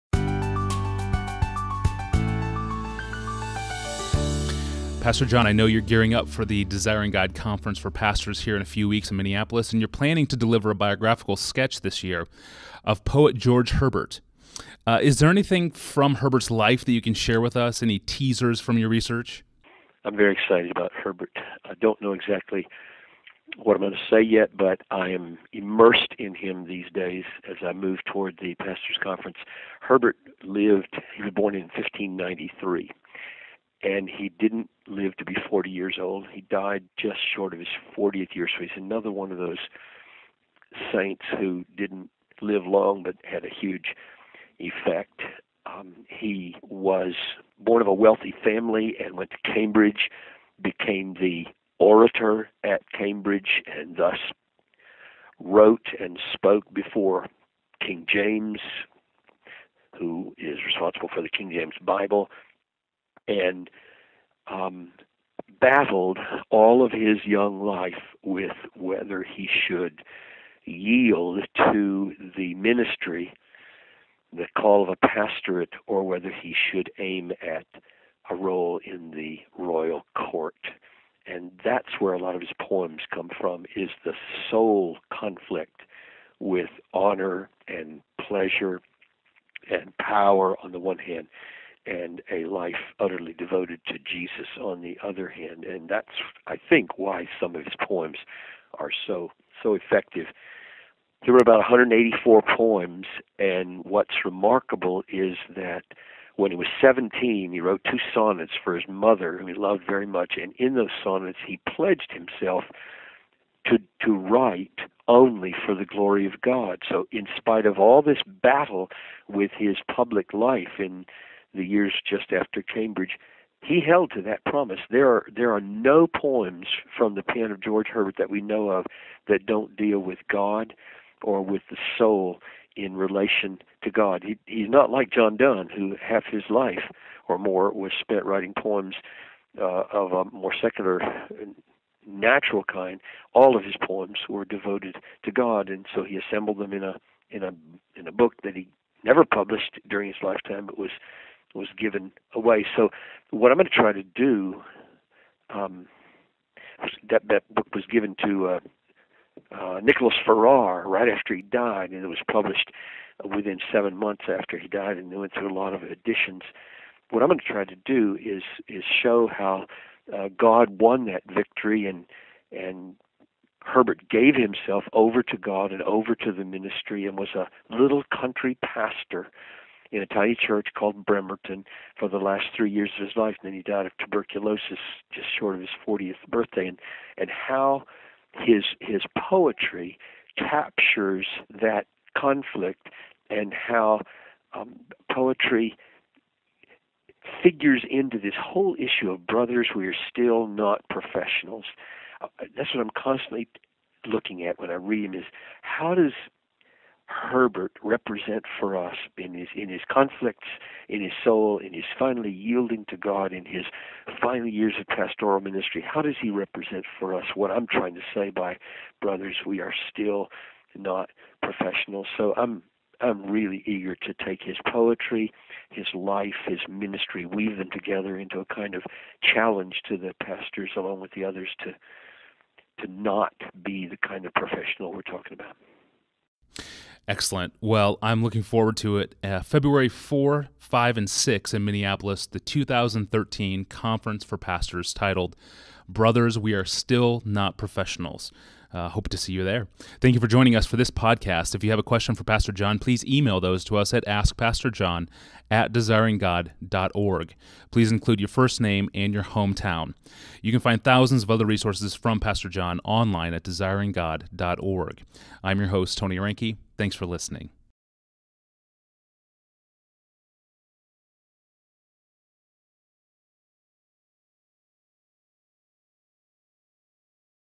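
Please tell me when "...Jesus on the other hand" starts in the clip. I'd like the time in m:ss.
1:33.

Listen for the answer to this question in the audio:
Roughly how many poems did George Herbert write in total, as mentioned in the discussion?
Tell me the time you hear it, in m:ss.
1:41.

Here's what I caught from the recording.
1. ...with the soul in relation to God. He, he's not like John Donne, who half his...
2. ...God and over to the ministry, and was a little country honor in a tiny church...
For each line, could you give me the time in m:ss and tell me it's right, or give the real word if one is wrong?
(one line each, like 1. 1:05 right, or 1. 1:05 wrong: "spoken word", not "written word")
1. 2:11 right
2. 2:55 wrong: "pastor", not "honor".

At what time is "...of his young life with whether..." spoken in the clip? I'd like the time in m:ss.
1:06.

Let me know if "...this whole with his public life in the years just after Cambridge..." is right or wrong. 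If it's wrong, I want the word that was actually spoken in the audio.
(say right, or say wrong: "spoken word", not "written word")
wrong: "battle", not "whole".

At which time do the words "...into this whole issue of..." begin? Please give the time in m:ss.
3:17.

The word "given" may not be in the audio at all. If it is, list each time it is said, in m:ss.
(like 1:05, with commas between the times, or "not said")
2:31, 2:37.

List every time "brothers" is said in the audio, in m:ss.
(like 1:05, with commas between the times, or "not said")
3:19, 3:39, 4:05.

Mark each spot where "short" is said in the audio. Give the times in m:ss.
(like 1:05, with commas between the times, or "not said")
0:37, 3:05.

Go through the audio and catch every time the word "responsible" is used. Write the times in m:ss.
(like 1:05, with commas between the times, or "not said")
1:00.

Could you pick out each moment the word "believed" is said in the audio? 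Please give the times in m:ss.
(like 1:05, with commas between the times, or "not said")
not said.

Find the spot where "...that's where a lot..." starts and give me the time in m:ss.
1:21.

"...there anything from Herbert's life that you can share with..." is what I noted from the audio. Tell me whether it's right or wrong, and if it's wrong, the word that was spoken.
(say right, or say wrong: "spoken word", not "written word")
right.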